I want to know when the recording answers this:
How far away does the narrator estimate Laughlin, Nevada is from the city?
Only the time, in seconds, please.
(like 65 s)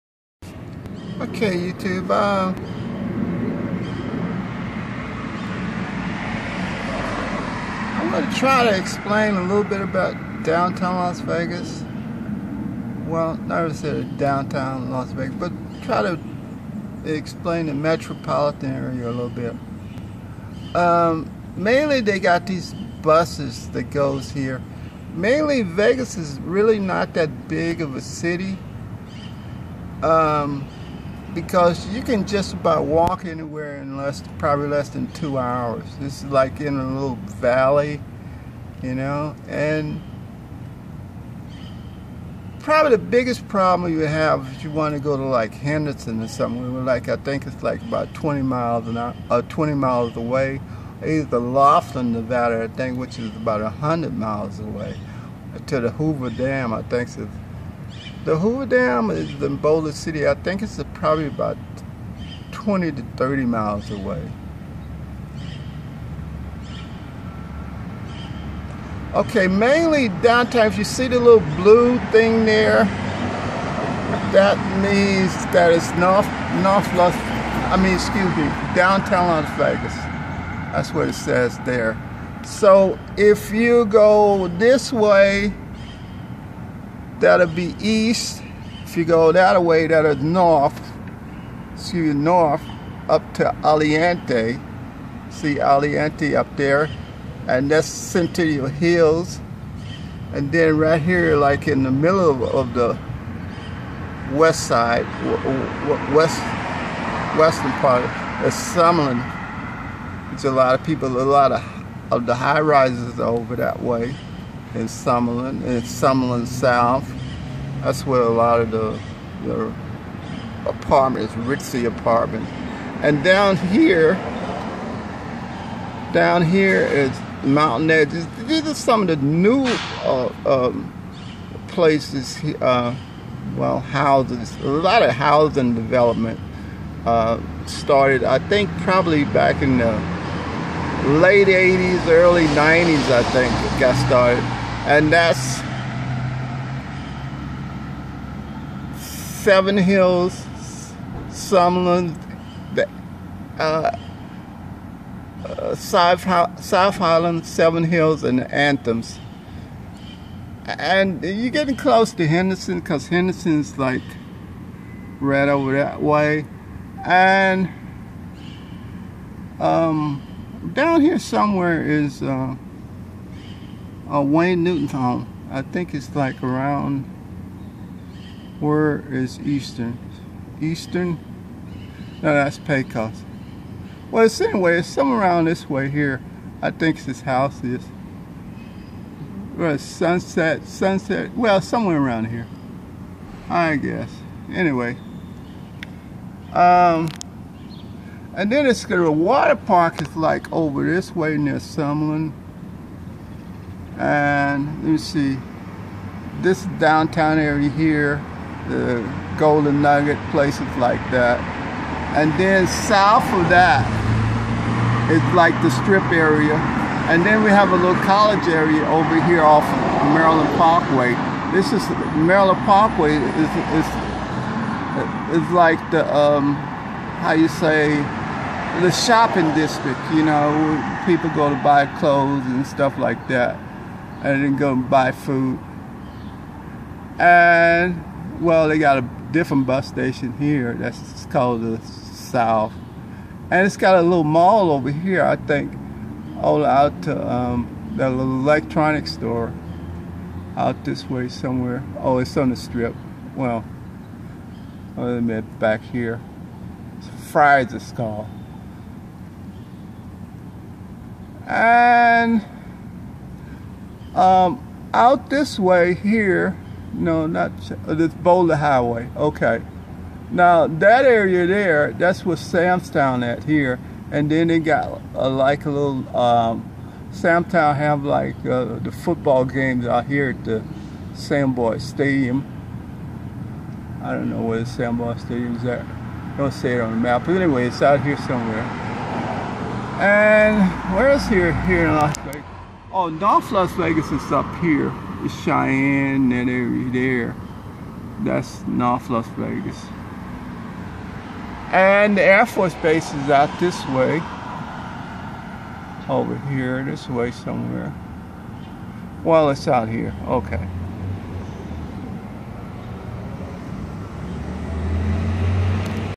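53 s.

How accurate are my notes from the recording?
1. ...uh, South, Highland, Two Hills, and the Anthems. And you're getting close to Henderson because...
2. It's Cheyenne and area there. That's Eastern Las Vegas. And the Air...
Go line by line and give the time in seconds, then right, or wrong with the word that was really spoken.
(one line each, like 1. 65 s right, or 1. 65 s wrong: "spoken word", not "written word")
1. 155 s wrong: "Seven", not "Two"
2. 295 s wrong: "North", not "Eastern".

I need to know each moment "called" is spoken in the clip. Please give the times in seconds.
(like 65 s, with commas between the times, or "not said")
241 s, 257 s.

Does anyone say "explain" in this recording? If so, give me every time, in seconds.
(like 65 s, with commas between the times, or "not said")
8 s, 17 s.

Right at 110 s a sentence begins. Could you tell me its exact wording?
It's a lot of people, a lot of, of the high rises over that way in Summerlin, in Summerlin South.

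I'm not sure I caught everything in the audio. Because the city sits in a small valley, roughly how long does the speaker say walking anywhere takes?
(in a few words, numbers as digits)
less than 2 hours.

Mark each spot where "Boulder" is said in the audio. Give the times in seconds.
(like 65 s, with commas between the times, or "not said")
59 s, 268 s.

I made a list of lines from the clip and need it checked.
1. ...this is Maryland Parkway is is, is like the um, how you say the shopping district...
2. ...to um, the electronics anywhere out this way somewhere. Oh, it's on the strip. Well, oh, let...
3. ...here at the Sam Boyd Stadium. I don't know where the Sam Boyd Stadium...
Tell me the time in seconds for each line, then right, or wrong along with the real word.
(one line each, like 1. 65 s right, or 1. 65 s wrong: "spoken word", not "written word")
1. 221 s right
2. 247 s wrong: "store", not "anywhere"
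3. 280 s right.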